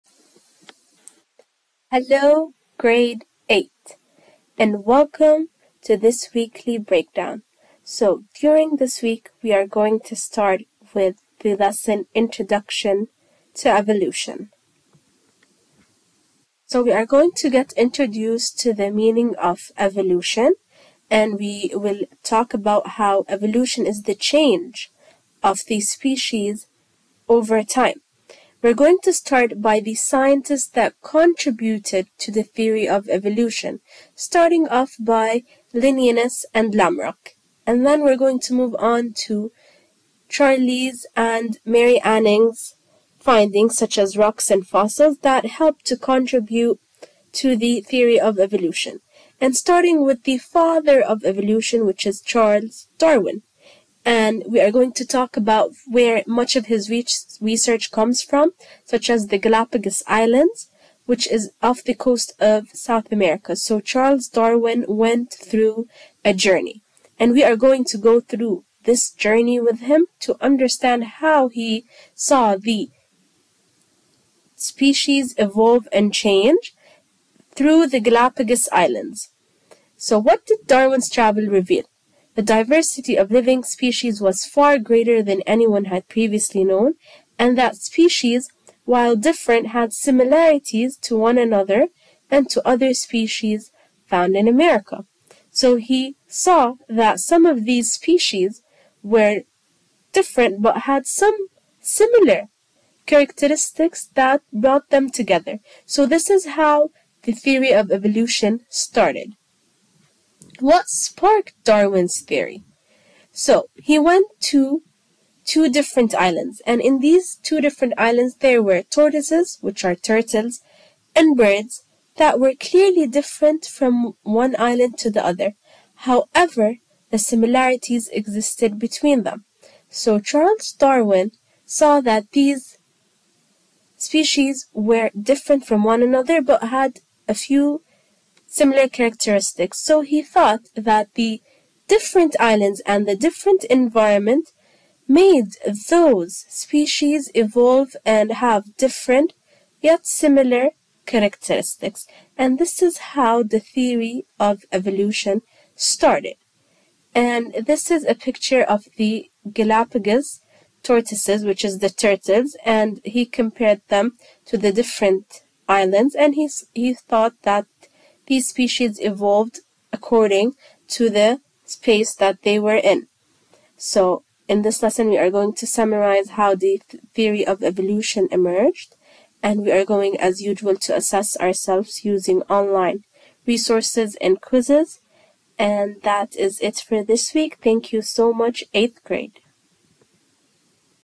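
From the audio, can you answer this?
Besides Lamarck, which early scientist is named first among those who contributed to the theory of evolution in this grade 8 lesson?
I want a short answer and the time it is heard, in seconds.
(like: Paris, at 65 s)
Linnaeus, at 35 s.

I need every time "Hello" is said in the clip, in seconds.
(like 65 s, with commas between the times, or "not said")
1 s.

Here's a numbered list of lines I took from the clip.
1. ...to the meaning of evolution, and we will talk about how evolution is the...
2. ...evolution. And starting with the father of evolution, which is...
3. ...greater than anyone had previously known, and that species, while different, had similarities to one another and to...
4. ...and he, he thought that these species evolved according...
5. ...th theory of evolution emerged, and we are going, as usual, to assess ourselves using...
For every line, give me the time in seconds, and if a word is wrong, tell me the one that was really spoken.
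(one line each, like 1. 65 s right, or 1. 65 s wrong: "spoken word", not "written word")
1. 18 s right
2. 48 s right
3. 84 s right
4. 166 s right
5. 176 s right.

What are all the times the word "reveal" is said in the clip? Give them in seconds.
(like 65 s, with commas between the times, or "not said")
81 s.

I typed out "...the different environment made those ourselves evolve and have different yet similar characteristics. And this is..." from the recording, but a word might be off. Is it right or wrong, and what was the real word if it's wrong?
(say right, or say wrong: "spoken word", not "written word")
wrong: "species", not "ourselves".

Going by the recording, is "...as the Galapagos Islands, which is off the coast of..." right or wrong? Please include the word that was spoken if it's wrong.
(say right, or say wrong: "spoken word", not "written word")
right.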